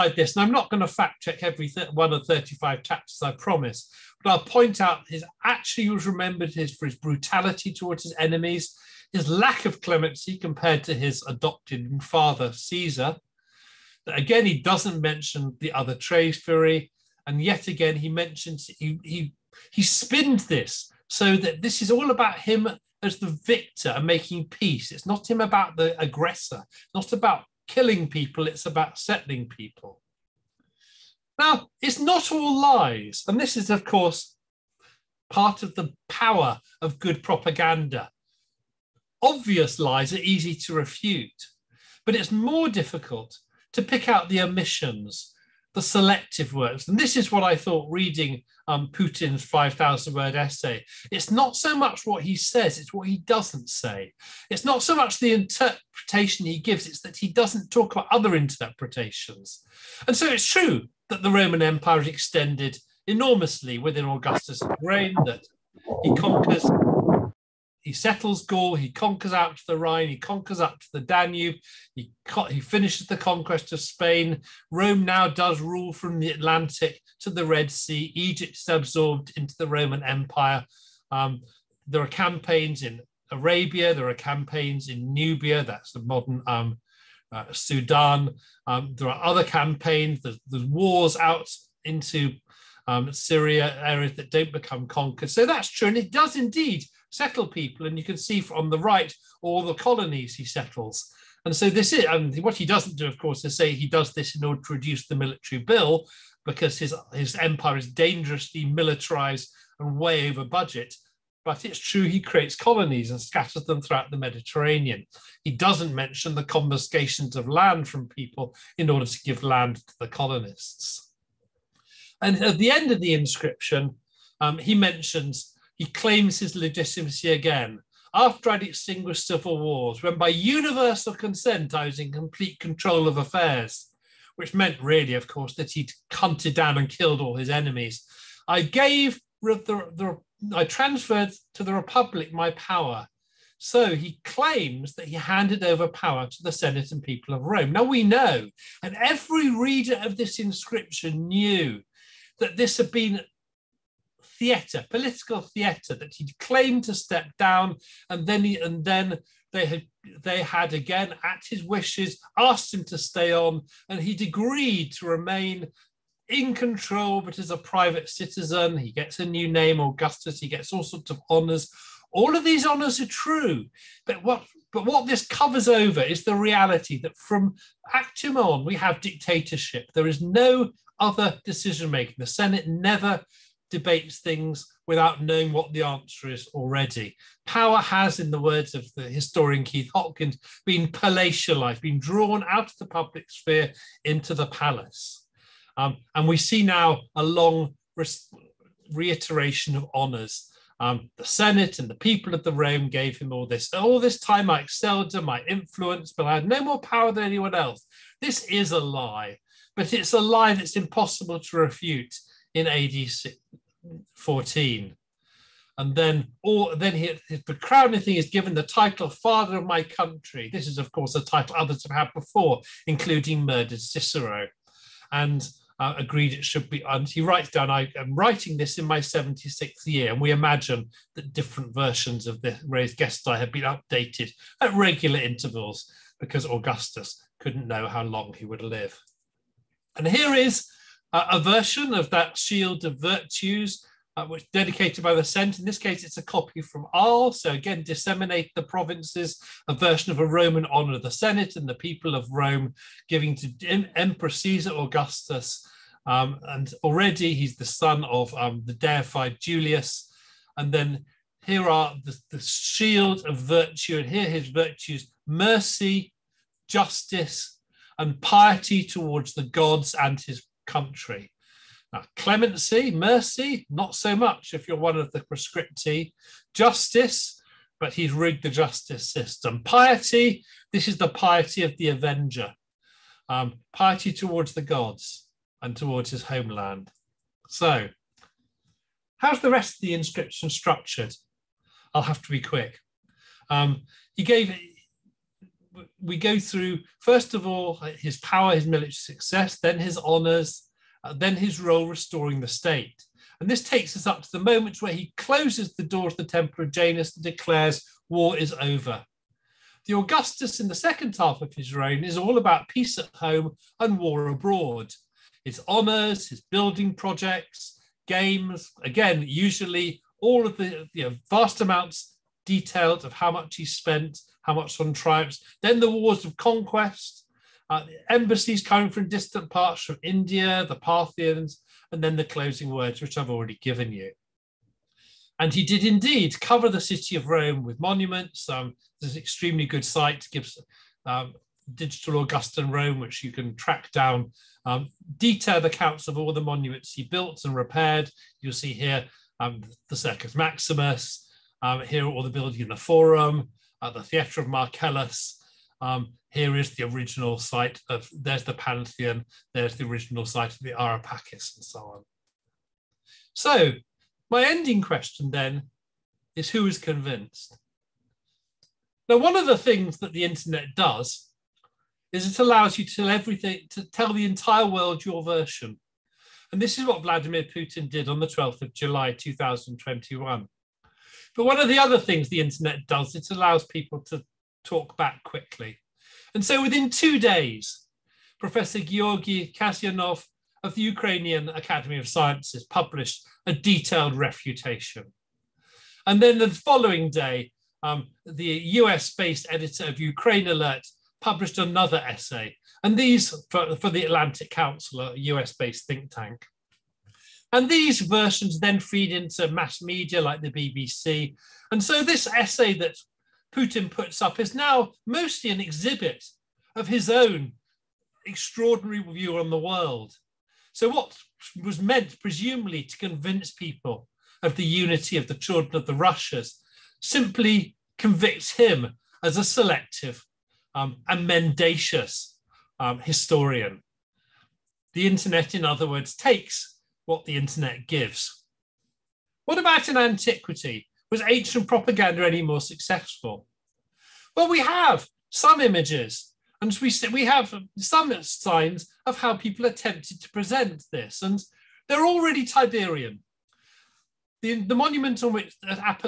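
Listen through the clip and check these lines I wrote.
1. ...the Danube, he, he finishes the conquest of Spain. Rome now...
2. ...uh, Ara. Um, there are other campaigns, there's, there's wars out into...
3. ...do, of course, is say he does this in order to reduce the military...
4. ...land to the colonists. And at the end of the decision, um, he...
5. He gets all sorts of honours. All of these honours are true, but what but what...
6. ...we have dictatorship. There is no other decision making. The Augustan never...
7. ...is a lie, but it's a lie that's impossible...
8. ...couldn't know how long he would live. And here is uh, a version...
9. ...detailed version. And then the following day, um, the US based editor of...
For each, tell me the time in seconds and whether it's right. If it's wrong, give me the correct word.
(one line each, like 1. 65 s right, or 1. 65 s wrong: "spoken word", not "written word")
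1. 70 s right
2. 87 s wrong: "Sudan", not "Ara"
3. 102 s right
4. 119 s wrong: "inscription", not "decision"
5. 170 s right
6. 178 s wrong: "Senate", not "Augustan"
7. 208 s right
8. 237 s right
9. 393 s wrong: "refutation", not "version".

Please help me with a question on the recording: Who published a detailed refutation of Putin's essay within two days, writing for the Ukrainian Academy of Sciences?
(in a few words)
Georgi Kasyanov.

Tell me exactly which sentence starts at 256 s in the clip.
Um, and already he's the son of um, the deified Julius.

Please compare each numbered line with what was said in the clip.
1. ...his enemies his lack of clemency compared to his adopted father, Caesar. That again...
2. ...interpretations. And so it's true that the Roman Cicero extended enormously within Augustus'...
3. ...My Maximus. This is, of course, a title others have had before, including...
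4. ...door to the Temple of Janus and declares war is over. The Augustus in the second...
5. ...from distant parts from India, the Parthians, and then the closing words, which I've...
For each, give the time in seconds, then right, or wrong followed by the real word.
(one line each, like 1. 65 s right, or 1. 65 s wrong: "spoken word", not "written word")
1. 8 s right
2. 58 s wrong: "Empire", not "Cicero"
3. 219 s wrong: "Country", not "Maximus"
4. 305 s right
5. 328 s right.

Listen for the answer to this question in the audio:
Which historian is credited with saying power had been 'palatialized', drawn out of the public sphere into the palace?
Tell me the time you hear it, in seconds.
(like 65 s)
189 s.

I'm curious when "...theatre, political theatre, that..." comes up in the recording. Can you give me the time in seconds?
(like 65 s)
154 s.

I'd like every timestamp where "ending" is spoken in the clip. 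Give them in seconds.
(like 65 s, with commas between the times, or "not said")
364 s.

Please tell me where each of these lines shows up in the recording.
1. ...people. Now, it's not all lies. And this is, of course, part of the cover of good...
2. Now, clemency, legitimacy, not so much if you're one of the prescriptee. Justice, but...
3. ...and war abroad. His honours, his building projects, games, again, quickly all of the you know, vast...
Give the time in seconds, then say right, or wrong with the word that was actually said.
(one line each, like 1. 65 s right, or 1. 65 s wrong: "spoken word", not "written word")
1. 29 s wrong: "power", not "cover"
2. 271 s wrong: "mercy", not "legitimacy"
3. 313 s wrong: "usually", not "quickly".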